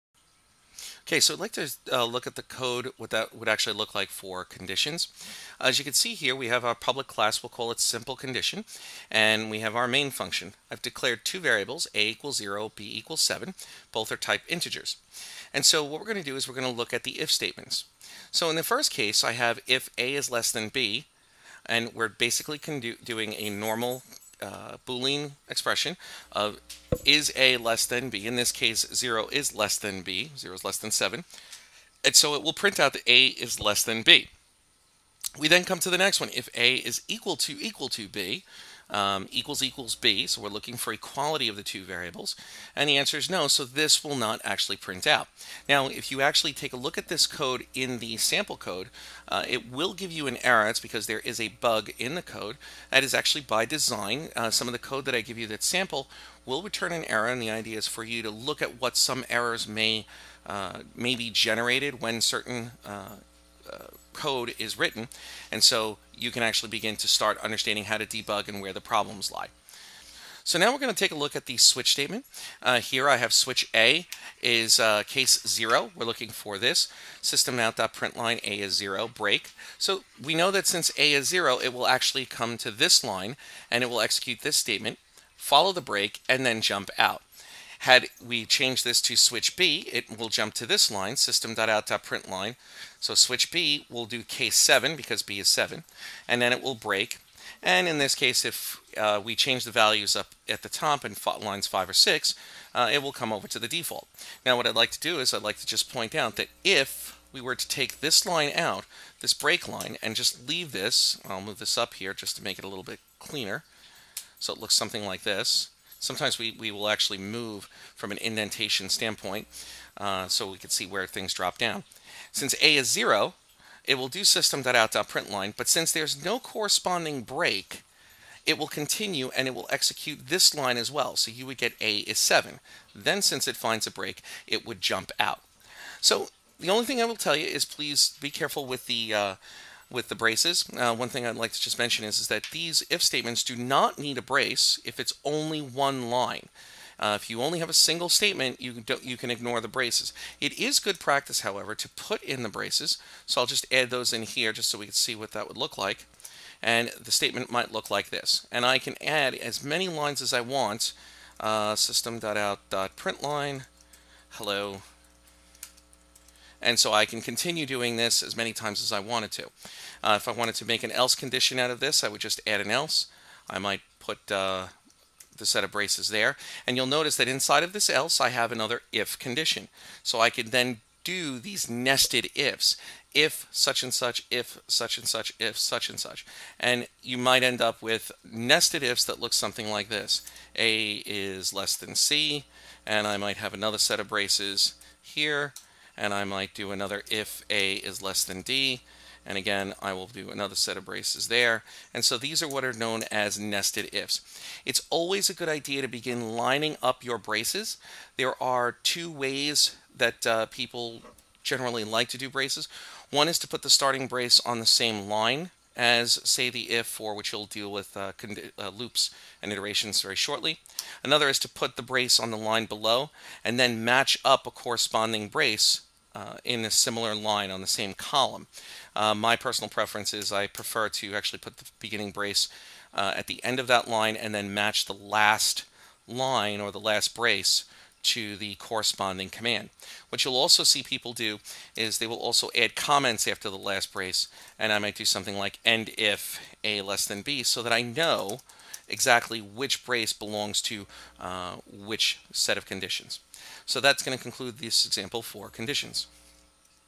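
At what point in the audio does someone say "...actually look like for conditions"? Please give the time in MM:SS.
00:03.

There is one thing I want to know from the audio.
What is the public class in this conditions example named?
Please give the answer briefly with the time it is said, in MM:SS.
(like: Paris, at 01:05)
simple condition, at 00:07.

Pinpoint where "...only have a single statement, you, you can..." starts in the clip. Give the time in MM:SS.
02:27.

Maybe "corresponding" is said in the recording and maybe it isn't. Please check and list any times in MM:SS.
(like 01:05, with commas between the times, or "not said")
02:06, 03:44, 03:58.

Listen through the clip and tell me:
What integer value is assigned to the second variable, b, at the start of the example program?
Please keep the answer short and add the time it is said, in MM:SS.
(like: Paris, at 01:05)
7, at 00:12.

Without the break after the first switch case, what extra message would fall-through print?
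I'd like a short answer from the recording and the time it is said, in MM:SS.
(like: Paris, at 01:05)
A is 7, at 02:11.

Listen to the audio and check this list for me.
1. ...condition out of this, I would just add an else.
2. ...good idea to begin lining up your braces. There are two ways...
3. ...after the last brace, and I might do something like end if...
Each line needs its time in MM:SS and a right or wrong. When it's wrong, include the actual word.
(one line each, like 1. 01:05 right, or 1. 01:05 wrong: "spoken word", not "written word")
1. 02:51 right
2. 03:25 right
3. 04:03 right.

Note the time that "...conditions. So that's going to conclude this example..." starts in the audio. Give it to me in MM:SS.
04:12.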